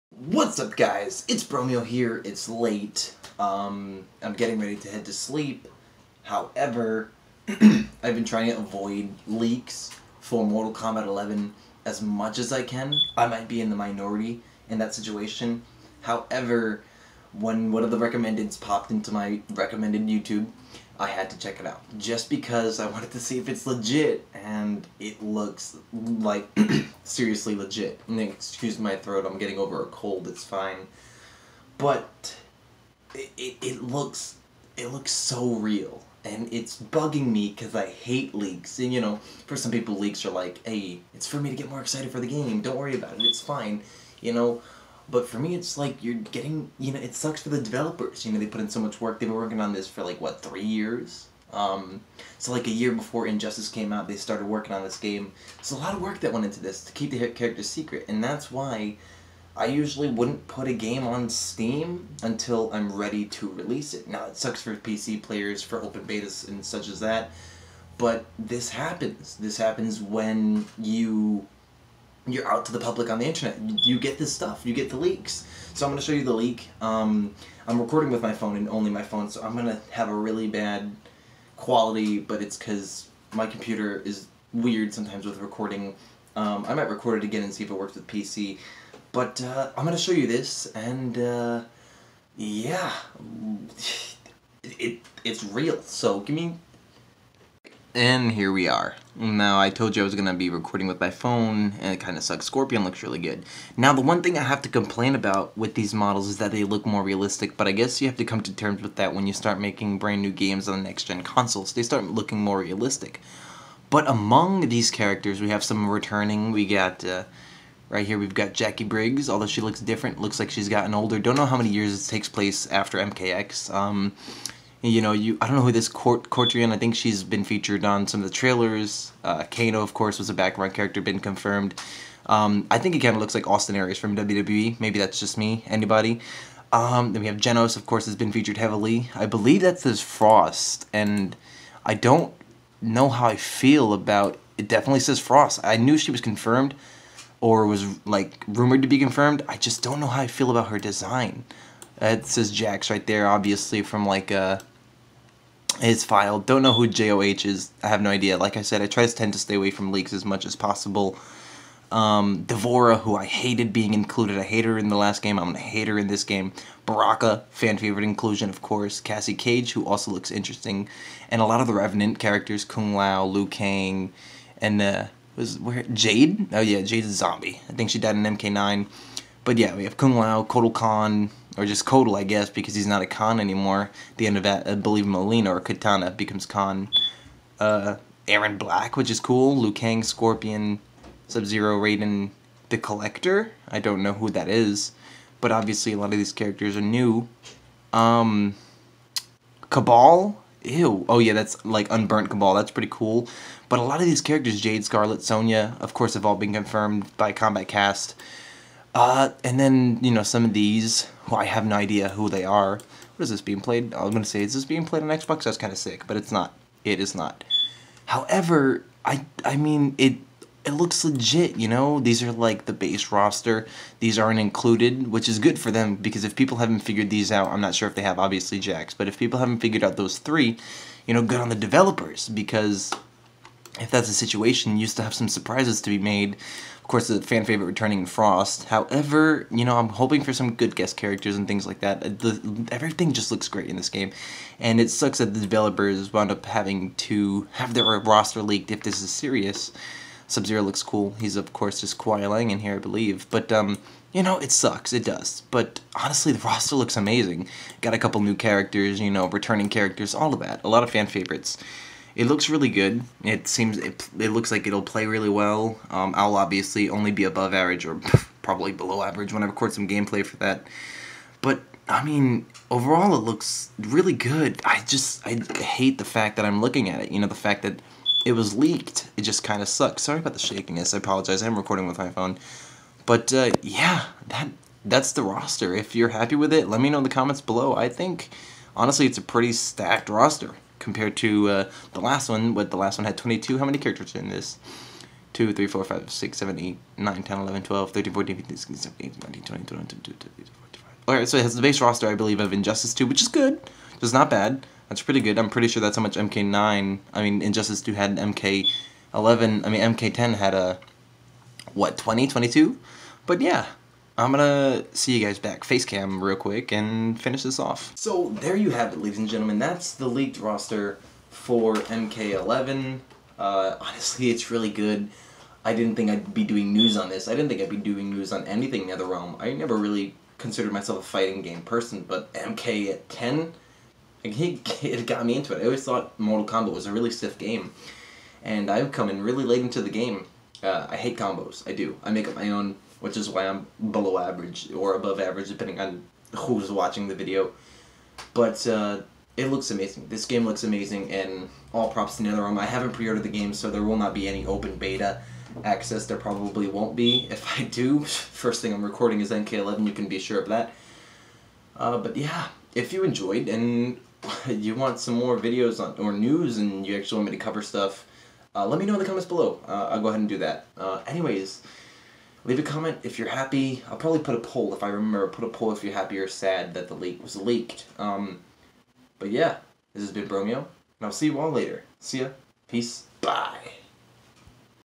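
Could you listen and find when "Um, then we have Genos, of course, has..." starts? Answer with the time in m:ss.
2:16.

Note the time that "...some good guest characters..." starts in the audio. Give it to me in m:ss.
4:00.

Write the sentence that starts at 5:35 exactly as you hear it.
I always thought Mortal Kombat was a really stiff game, and I've come in really late into the game.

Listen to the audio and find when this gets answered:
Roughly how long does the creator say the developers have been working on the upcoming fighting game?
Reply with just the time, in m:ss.
0:50.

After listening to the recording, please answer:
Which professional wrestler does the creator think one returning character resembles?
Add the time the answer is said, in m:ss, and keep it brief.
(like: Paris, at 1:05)
Austin Aries, at 2:13.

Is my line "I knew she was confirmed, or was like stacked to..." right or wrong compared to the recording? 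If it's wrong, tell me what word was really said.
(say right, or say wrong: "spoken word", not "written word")
wrong: "rumored", not "stacked".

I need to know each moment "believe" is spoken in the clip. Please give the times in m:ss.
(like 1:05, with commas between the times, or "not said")
2:19, 3:04, 4:12, 5:02.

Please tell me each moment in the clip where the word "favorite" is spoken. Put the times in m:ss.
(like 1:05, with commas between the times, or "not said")
2:47, 3:57, 4:21.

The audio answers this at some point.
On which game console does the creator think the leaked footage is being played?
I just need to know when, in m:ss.
3:35.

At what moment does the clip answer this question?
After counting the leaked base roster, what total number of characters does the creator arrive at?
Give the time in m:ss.
5:00.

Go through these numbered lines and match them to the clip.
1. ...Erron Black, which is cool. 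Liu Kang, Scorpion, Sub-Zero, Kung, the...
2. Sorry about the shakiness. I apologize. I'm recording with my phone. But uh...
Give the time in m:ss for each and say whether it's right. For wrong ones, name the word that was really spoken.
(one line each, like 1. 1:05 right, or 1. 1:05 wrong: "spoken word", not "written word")
1. 3:08 wrong: "Raiden", not "Kung"
2. 4:40 right.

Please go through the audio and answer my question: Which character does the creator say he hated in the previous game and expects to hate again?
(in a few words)
D'Vorah.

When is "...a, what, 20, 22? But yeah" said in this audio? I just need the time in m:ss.
5:10.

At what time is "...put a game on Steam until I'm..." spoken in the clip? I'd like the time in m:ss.
1:00.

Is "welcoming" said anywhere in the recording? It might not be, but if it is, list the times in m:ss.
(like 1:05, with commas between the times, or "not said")
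not said.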